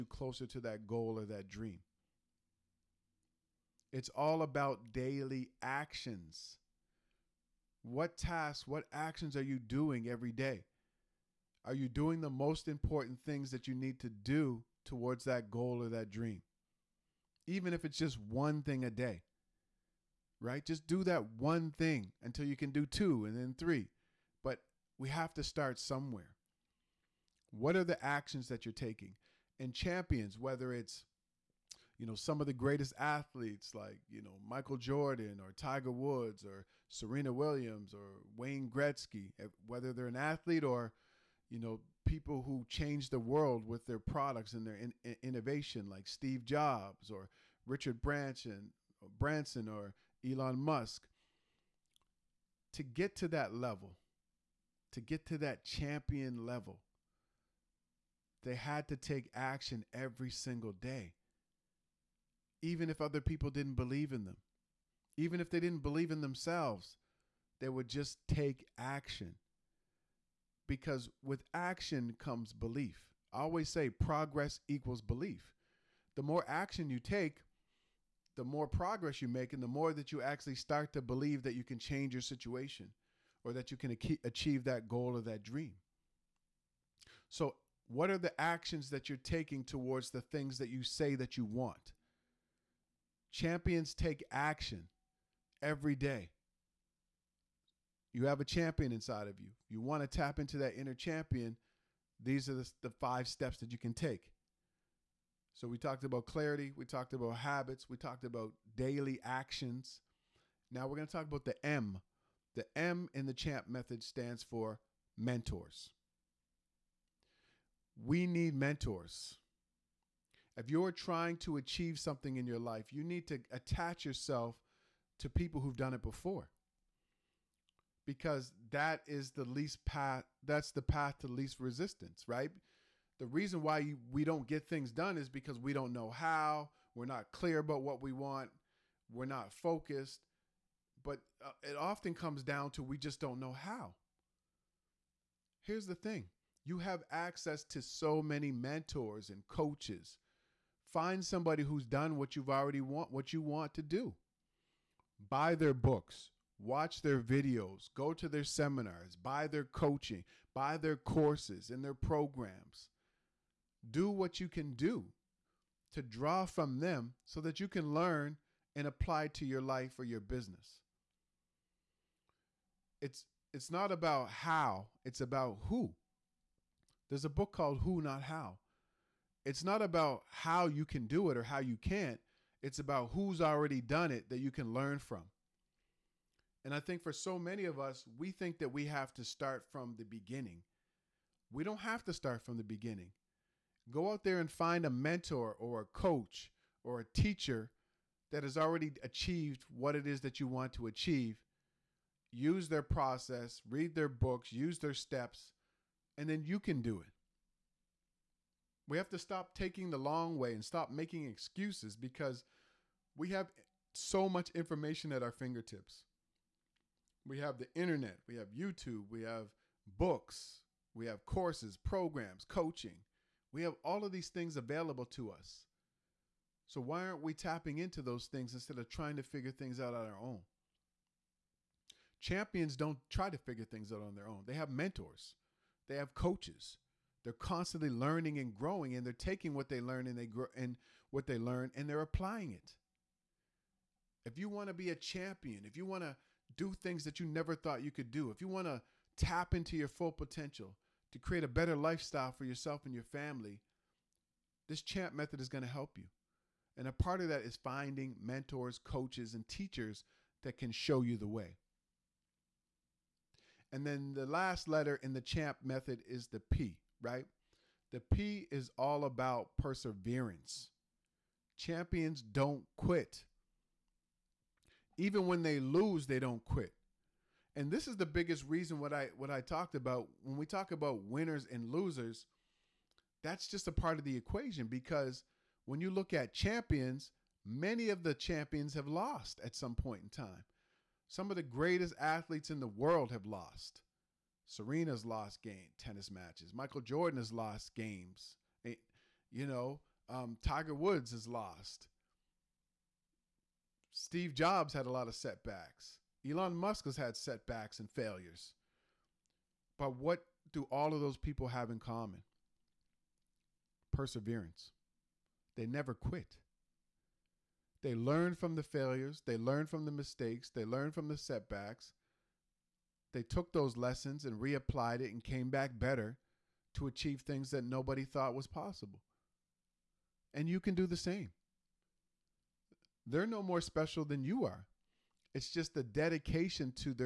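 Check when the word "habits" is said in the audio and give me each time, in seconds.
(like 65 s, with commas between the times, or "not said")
107 s.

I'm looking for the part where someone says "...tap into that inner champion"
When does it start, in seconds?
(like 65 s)
100 s.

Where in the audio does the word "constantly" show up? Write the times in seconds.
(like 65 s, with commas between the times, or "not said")
237 s.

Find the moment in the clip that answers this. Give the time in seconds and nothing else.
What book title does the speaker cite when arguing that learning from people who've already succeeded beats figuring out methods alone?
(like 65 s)
177 s.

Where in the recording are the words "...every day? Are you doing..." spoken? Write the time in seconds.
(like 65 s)
10 s.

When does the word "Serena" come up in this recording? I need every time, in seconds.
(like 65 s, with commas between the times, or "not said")
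36 s, 294 s.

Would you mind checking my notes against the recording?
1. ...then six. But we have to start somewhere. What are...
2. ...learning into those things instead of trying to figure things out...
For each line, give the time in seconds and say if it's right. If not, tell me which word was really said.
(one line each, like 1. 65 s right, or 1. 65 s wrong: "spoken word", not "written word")
1. 23 s wrong: "three", not "six"
2. 227 s wrong: "tapping", not "learning".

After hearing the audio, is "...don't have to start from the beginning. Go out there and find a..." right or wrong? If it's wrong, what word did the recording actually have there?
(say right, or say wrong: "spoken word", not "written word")
right.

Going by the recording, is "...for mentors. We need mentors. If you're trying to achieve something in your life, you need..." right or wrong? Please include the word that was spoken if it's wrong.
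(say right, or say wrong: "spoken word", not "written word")
right.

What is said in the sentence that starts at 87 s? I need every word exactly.
So, what are the actions that you're taking towards the things that you say that you want?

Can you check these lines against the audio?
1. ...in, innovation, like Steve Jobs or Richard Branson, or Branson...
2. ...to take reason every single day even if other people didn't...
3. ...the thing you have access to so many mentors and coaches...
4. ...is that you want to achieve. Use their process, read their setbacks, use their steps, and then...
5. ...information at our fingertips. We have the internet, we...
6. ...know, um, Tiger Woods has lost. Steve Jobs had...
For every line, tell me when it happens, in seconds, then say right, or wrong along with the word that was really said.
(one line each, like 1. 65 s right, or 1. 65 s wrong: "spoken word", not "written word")
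1. 45 s right
2. 58 s wrong: "action", not "reason"
3. 145 s right
4. 200 s wrong: "books", not "setbacks"
5. 214 s right
6. 299 s right.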